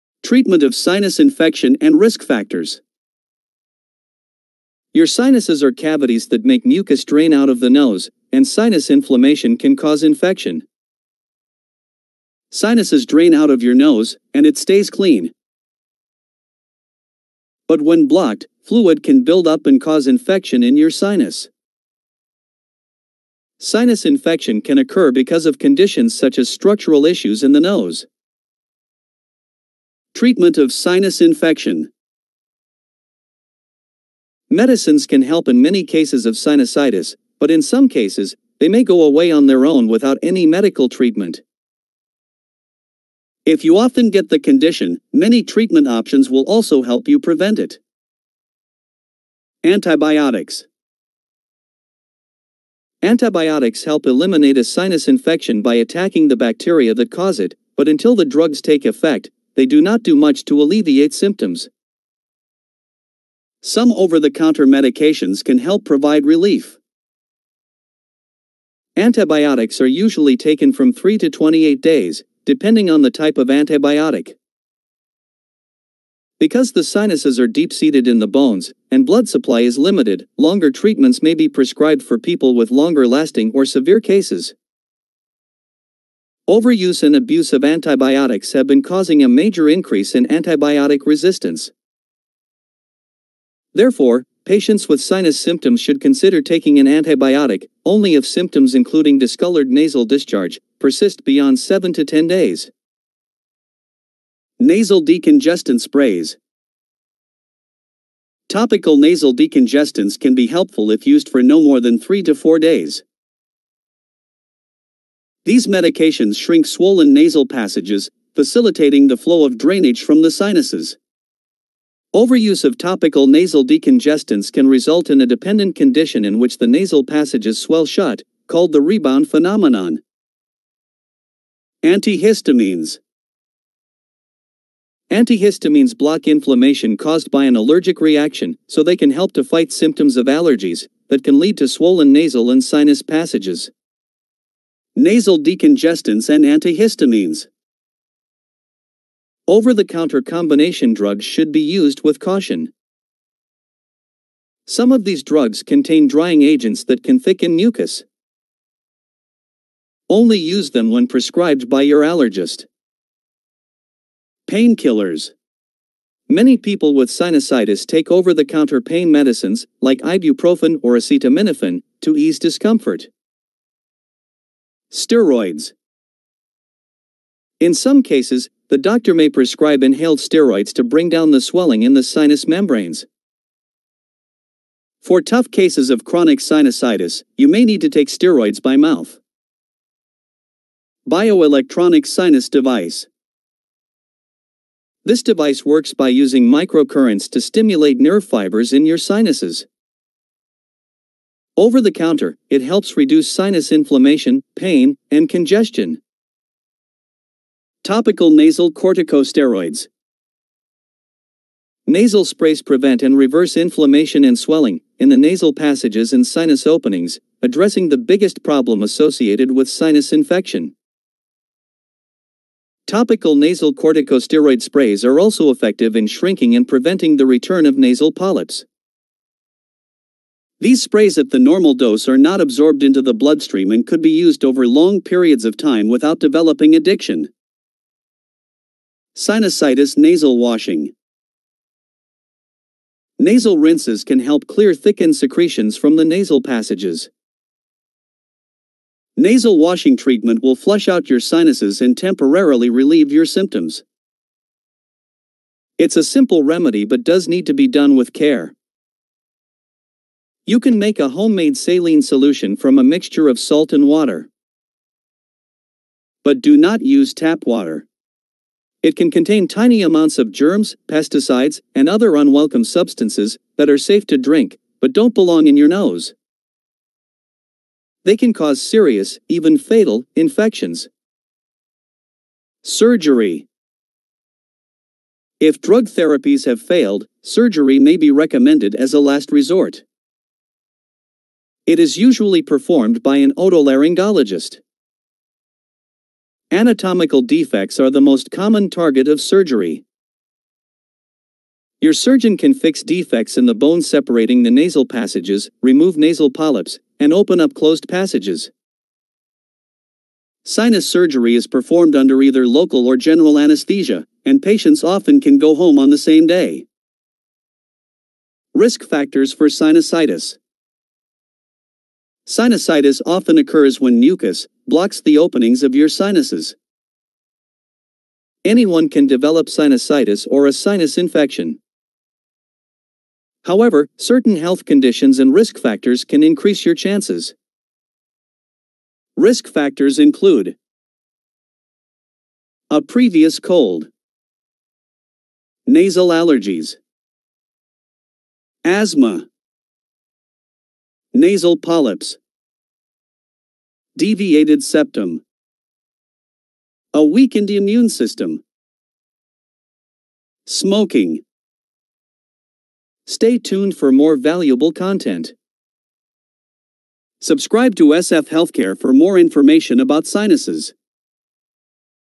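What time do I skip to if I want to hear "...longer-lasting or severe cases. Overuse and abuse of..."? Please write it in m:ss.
1:22.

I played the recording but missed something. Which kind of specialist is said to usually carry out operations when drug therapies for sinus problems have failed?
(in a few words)
otolaryngologist.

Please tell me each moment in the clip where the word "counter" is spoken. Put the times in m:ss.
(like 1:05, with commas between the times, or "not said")
1:03, 2:29, 2:48, 3:21.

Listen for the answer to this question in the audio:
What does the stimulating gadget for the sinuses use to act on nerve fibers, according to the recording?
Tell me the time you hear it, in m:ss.
3:16.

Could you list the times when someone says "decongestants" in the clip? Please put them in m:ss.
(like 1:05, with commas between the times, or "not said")
1:45, 1:49, 2:03, 2:25.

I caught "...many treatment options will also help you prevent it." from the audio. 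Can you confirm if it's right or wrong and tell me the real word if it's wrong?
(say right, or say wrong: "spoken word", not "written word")
right.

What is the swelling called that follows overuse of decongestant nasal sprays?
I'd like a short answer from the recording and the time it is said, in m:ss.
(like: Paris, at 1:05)
rebound phenomenon, at 2:08.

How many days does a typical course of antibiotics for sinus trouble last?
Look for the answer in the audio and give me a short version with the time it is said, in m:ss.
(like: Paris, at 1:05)
3 to 28 days, at 1:10.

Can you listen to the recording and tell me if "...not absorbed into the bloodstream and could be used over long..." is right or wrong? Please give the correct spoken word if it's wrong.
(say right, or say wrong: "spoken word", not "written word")
right.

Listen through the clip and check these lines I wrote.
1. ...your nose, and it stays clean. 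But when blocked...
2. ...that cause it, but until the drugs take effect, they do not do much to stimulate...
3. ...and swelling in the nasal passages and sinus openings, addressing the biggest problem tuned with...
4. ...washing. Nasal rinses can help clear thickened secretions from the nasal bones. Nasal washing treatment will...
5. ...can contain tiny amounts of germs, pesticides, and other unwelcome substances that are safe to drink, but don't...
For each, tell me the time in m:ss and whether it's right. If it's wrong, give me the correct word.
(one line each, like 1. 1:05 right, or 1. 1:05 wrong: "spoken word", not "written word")
1. 0:13 right
2. 0:56 wrong: "alleviate", not "stimulate"
3. 3:34 wrong: "associated", not "tuned"
4. 4:00 wrong: "passages", not "bones"
5. 4:28 right.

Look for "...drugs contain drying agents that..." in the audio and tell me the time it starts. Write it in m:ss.
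2:35.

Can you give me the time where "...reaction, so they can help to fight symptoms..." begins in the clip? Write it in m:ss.
2:17.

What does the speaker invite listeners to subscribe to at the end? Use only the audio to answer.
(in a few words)
SF Healthcare.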